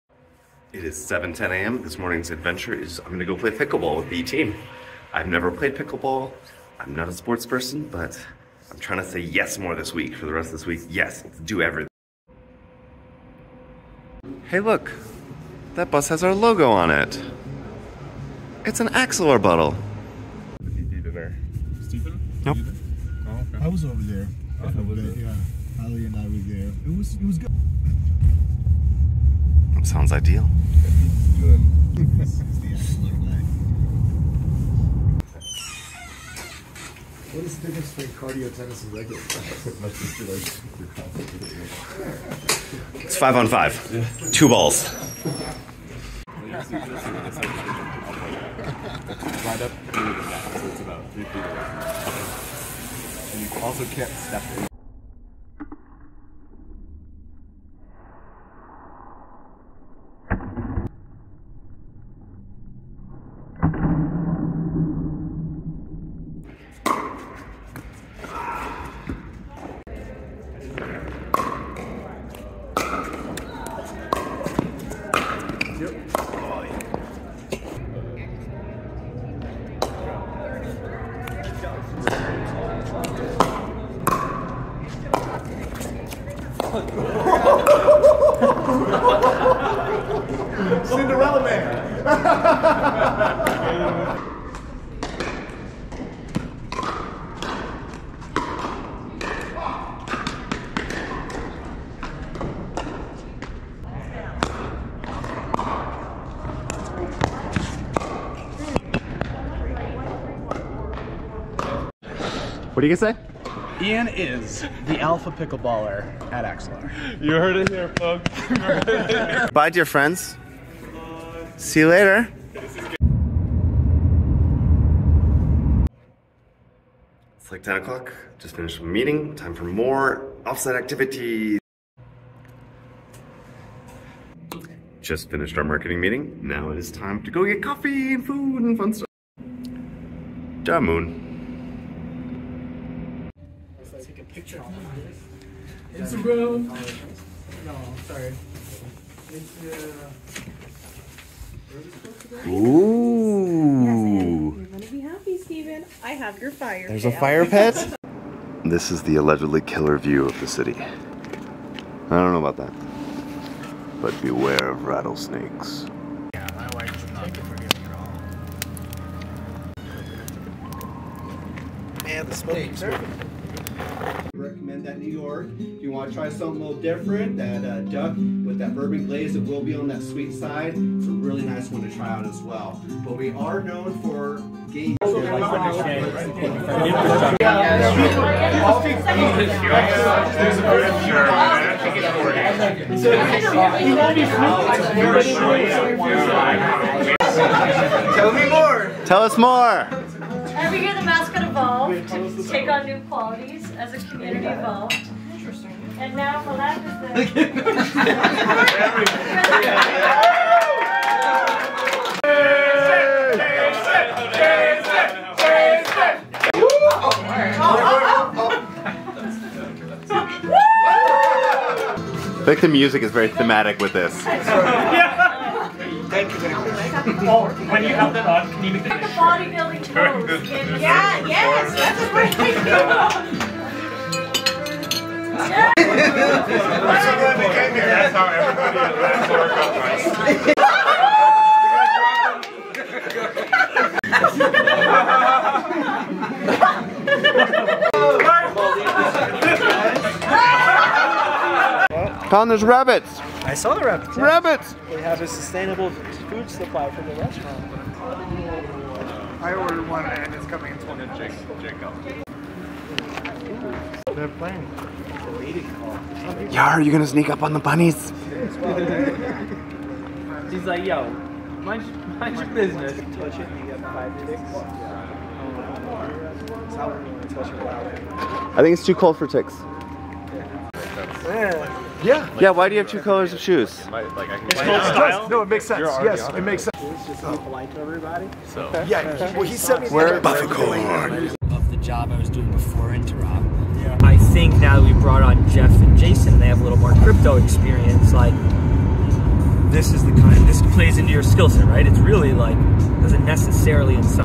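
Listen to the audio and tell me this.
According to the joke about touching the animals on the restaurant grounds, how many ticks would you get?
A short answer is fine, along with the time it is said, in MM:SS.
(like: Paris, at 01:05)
5, at 04:33.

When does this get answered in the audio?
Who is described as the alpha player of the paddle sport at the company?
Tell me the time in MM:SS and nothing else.
01:53.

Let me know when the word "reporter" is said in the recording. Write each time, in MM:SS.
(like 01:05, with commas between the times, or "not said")
not said.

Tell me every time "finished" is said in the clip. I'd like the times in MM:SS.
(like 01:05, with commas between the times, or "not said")
02:08, 02:15.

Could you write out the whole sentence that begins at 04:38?
I think it's too cold for ticks.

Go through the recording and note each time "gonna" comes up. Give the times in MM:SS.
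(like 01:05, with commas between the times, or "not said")
02:34, 04:26.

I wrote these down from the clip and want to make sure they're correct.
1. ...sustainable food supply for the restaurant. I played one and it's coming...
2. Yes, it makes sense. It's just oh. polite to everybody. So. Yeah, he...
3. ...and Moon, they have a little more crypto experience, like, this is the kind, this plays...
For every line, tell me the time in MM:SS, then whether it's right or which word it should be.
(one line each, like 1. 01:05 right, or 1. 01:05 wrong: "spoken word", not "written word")
1. 04:15 wrong: "ordered", not "played"
2. 04:46 right
3. 04:55 wrong: "Jason", not "Moon".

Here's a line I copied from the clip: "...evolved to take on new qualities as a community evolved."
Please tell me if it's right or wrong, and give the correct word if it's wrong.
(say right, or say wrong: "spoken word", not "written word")
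right.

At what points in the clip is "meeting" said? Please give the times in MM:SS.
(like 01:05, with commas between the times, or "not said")
02:08, 02:15.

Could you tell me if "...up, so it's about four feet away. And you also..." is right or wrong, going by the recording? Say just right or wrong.
wrong.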